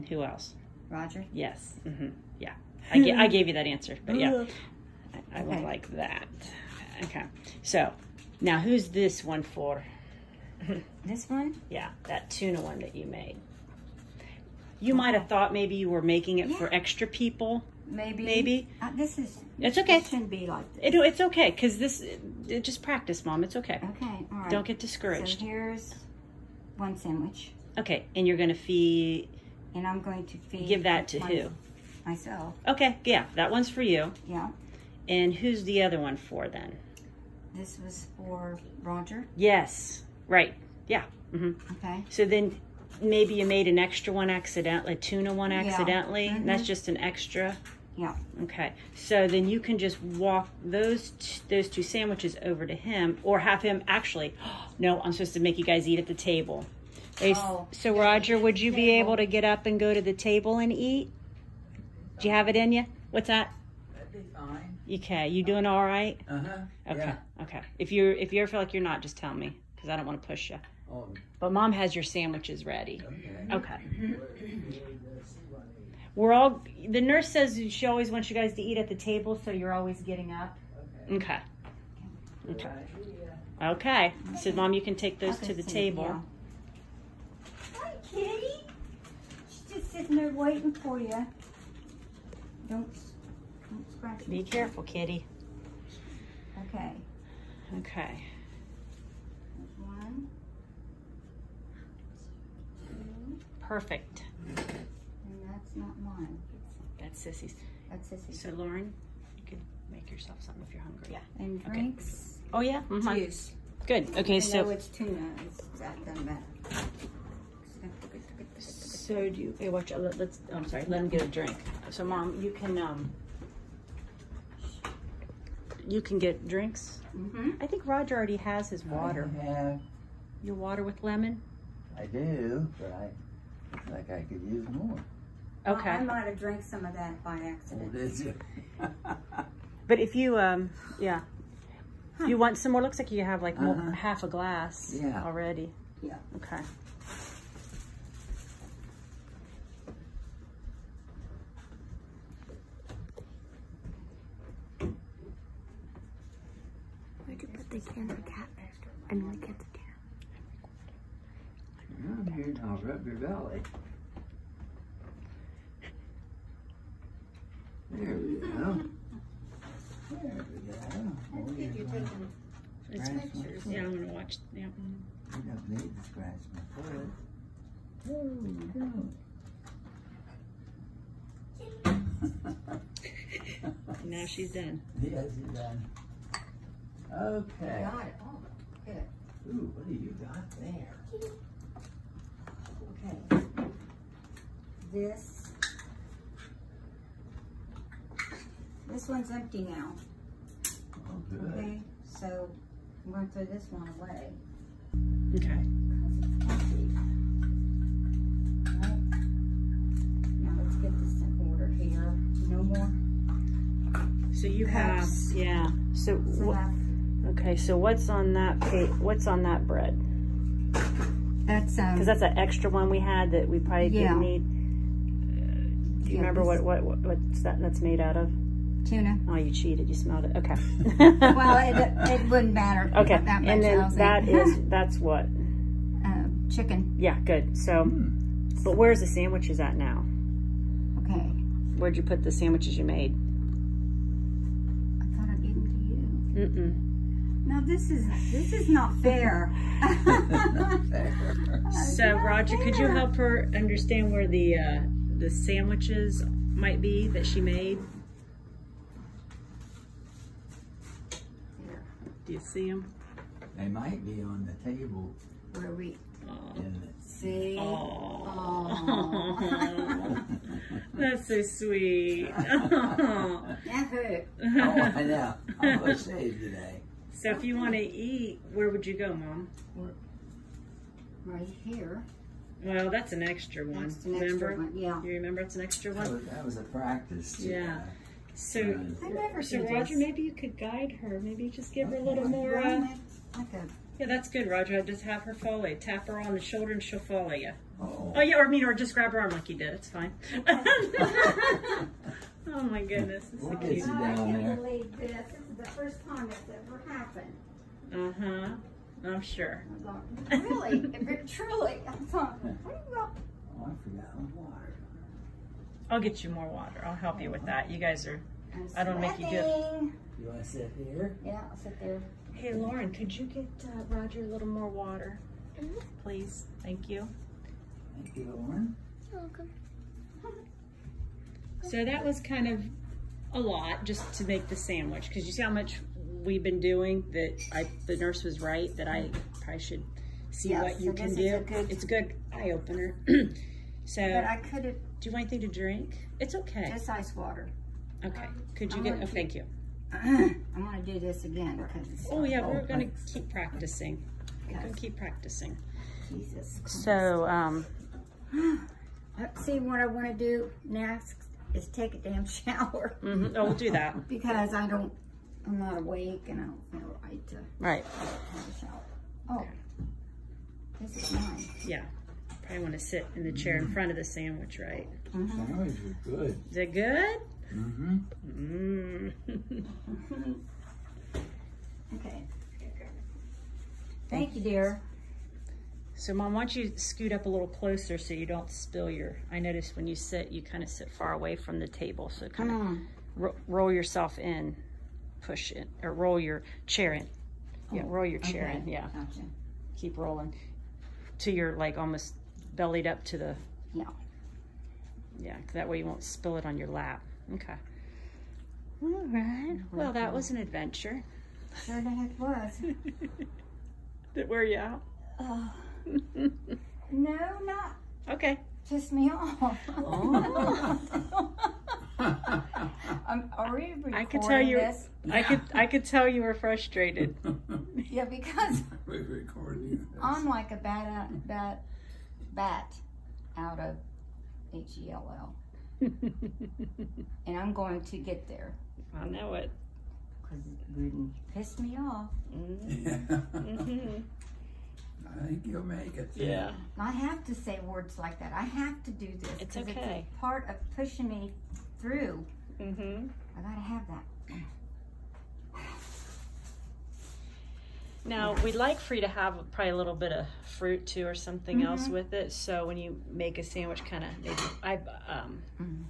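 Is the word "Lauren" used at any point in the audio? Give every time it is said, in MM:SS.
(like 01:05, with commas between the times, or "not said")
01:48, 05:22, 05:28.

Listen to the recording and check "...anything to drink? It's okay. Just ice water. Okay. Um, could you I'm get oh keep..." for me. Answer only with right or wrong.
right.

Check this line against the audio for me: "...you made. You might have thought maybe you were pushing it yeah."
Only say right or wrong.
wrong.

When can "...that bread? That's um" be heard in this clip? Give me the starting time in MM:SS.
03:39.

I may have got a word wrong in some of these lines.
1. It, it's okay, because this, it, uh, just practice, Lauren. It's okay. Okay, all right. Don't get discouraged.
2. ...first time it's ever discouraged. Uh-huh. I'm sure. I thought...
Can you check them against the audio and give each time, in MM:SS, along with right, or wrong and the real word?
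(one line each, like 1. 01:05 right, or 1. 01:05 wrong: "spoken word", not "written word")
1. 00:20 wrong: "Mom", not "Lauren"
2. 05:05 wrong: "happened", not "discouraged".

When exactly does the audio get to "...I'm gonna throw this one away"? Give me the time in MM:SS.
03:23.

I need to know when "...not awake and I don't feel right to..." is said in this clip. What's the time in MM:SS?
06:05.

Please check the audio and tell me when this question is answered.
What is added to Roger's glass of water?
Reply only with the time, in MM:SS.
02:10.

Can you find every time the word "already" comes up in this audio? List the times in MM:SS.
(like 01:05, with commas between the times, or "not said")
02:08, 02:25.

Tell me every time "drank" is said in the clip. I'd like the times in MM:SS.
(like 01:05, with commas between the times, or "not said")
02:16.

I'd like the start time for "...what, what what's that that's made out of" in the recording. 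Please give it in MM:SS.
03:46.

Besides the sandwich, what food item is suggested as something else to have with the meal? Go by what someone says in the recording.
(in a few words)
Fruit.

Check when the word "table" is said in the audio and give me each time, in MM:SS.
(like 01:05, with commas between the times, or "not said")
00:56, 01:00, 01:18, 01:25, 04:24, 06:31.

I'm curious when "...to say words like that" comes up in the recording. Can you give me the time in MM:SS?
07:27.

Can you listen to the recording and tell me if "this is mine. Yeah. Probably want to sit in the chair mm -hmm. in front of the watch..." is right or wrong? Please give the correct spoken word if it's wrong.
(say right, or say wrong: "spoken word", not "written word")
wrong: "sandwich", not "watch".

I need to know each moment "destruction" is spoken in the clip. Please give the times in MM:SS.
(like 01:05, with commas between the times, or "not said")
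not said.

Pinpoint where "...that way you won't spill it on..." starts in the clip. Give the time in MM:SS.
06:45.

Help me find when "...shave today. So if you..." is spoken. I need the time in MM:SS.
04:35.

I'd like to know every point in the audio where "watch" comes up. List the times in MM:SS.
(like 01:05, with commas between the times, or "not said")
01:59, 02:54.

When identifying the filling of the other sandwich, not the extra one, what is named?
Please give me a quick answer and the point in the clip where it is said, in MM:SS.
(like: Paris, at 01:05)
Chicken, at 03:56.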